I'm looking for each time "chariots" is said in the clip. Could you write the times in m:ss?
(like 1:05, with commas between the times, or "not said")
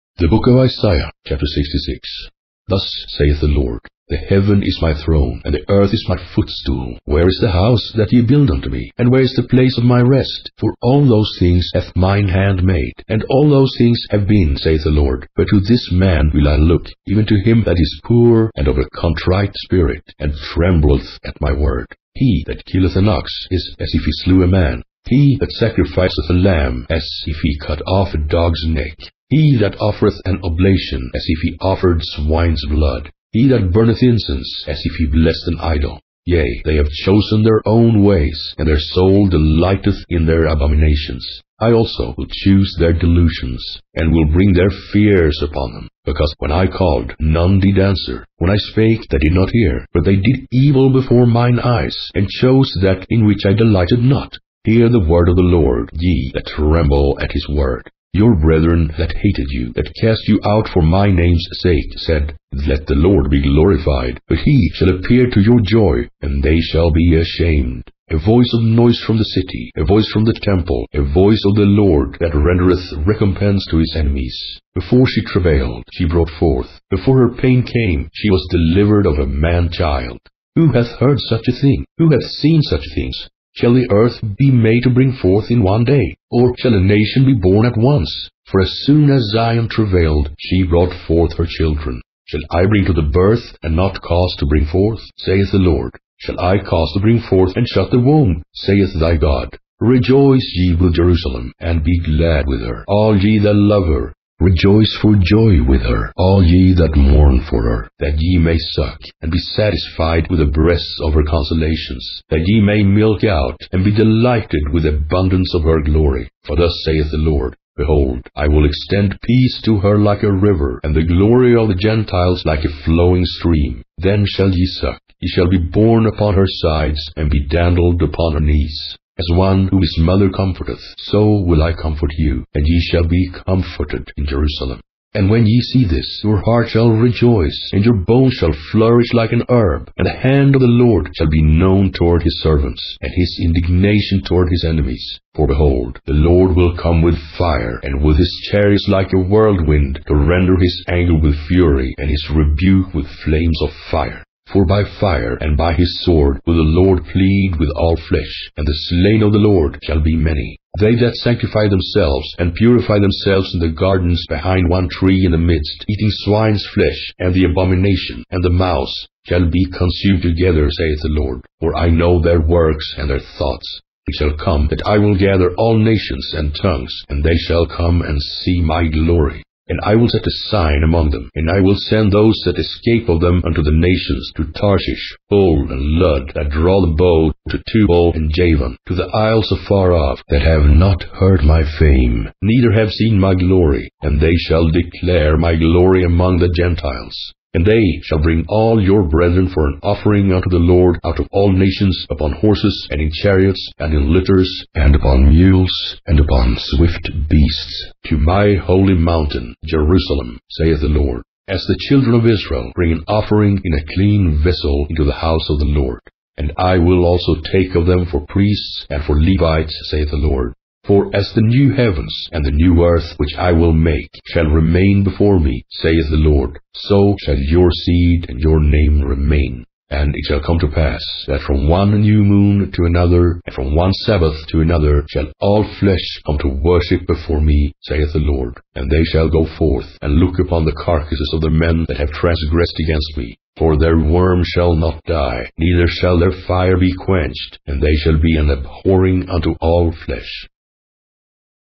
2:28, 3:23.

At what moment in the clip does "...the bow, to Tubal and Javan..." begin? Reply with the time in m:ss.
3:06.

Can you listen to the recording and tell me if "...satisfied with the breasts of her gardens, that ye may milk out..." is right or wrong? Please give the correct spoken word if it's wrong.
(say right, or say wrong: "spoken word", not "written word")
wrong: "consolations", not "gardens".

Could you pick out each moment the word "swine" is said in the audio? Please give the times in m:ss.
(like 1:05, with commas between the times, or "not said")
0:32, 2:46.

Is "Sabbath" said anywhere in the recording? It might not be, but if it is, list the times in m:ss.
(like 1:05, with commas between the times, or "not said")
3:54.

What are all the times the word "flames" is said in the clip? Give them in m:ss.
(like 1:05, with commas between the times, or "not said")
2:33.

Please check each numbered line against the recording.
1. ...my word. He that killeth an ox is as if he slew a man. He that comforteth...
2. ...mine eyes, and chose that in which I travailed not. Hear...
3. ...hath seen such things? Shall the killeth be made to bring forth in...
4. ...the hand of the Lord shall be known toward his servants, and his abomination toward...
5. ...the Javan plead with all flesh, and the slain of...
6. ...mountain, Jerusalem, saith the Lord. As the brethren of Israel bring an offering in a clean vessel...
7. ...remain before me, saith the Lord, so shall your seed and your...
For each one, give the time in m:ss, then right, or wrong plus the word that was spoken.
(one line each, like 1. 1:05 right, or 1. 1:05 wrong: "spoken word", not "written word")
1. 0:21 wrong: "sacrificeth", not "comforteth"
2. 0:51 wrong: "delighted", not "travailed"
3. 1:22 wrong: "earth", not "killeth"
4. 2:20 wrong: "indignation", not "abomination"
5. 2:36 wrong: "Lord", not "Javan"
6. 3:28 wrong: "children", not "brethren"
7. 3:44 right.